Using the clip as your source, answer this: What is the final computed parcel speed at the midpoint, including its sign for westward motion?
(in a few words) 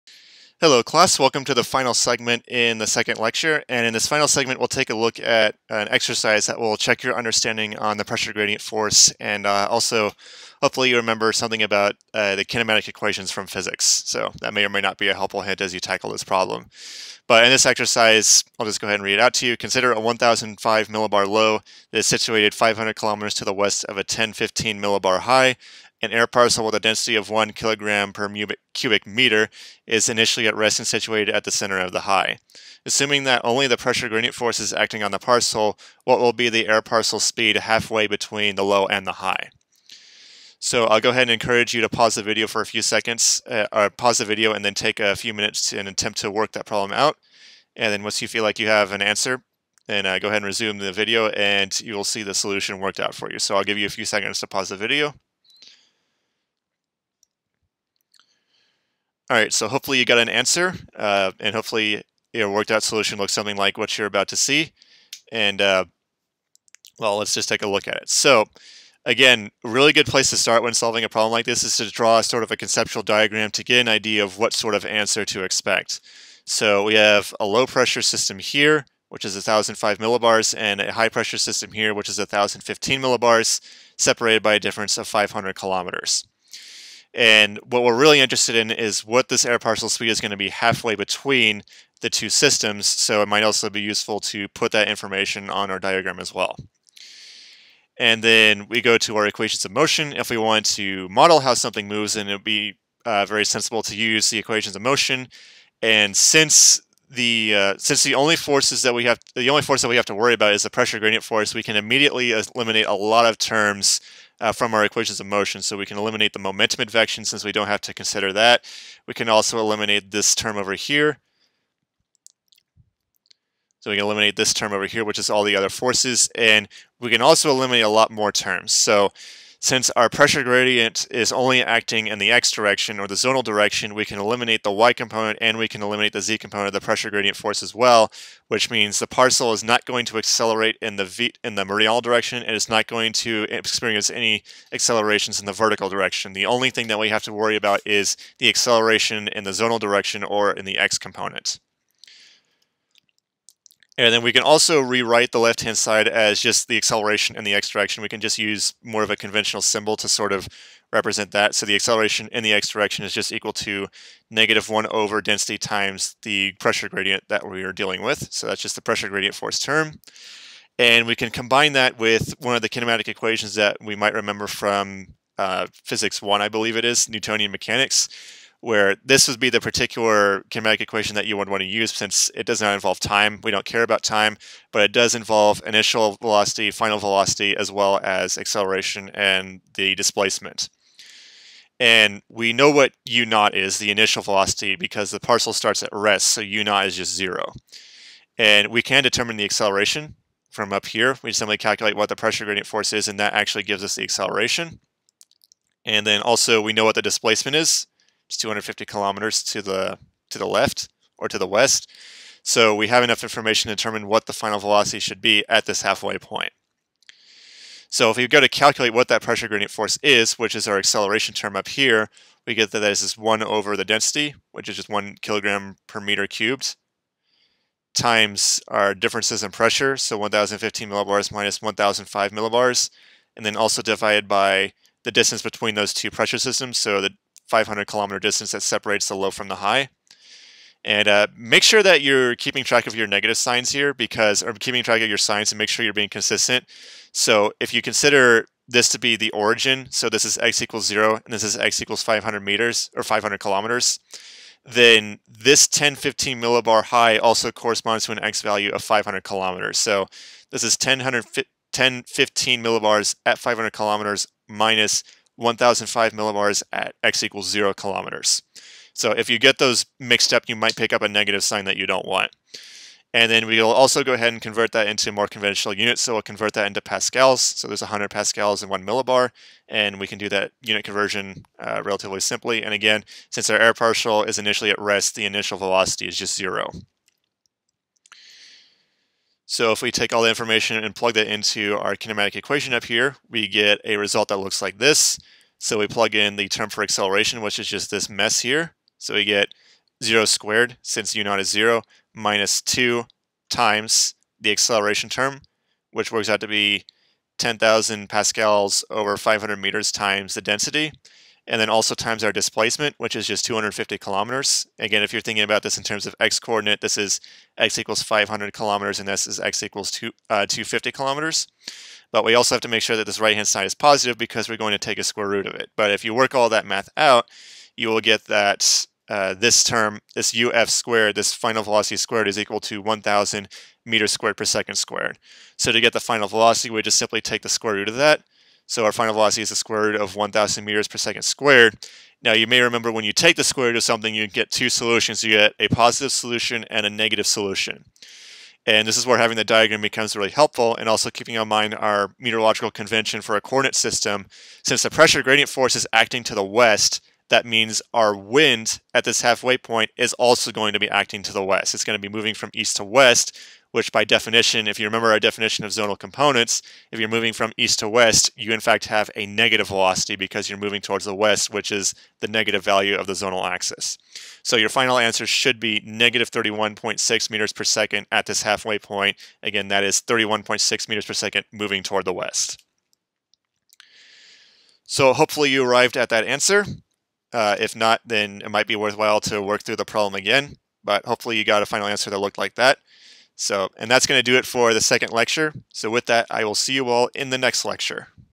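-31.6 meters per second.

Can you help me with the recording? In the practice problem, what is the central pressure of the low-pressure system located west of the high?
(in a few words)
1,005 millibars.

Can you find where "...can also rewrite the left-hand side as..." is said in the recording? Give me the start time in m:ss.
2:34.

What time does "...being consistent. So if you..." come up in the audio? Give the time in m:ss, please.
4:05.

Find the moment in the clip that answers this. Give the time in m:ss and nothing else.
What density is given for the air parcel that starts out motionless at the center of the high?
0:27.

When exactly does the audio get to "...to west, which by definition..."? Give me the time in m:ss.
6:02.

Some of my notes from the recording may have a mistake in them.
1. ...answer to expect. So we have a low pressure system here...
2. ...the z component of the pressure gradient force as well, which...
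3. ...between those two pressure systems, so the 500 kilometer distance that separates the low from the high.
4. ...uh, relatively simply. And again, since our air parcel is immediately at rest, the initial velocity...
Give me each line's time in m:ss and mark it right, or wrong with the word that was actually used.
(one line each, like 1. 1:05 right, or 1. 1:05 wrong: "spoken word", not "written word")
1. 1:14 right
2. 2:16 right
3. 3:55 right
4. 4:41 wrong: "initially", not "immediately".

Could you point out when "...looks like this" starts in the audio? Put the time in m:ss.
4:54.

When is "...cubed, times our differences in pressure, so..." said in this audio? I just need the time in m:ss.
3:46.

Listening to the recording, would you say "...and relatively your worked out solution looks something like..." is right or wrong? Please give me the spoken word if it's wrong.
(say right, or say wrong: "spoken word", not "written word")
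wrong: "hopefully", not "relatively".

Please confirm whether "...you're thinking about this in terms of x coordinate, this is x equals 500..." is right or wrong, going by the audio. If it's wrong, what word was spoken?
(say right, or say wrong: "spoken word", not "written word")
right.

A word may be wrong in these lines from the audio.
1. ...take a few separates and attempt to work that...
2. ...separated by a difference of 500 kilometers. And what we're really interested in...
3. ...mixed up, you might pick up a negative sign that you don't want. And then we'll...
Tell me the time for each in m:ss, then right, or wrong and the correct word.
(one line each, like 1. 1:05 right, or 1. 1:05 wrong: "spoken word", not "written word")
1. 0:44 wrong: "minutes", not "separates"
2. 1:23 right
3. 4:29 right.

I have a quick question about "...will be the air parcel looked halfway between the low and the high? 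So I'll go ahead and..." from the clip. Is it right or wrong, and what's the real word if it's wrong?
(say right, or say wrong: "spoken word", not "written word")
wrong: "speed", not "looked".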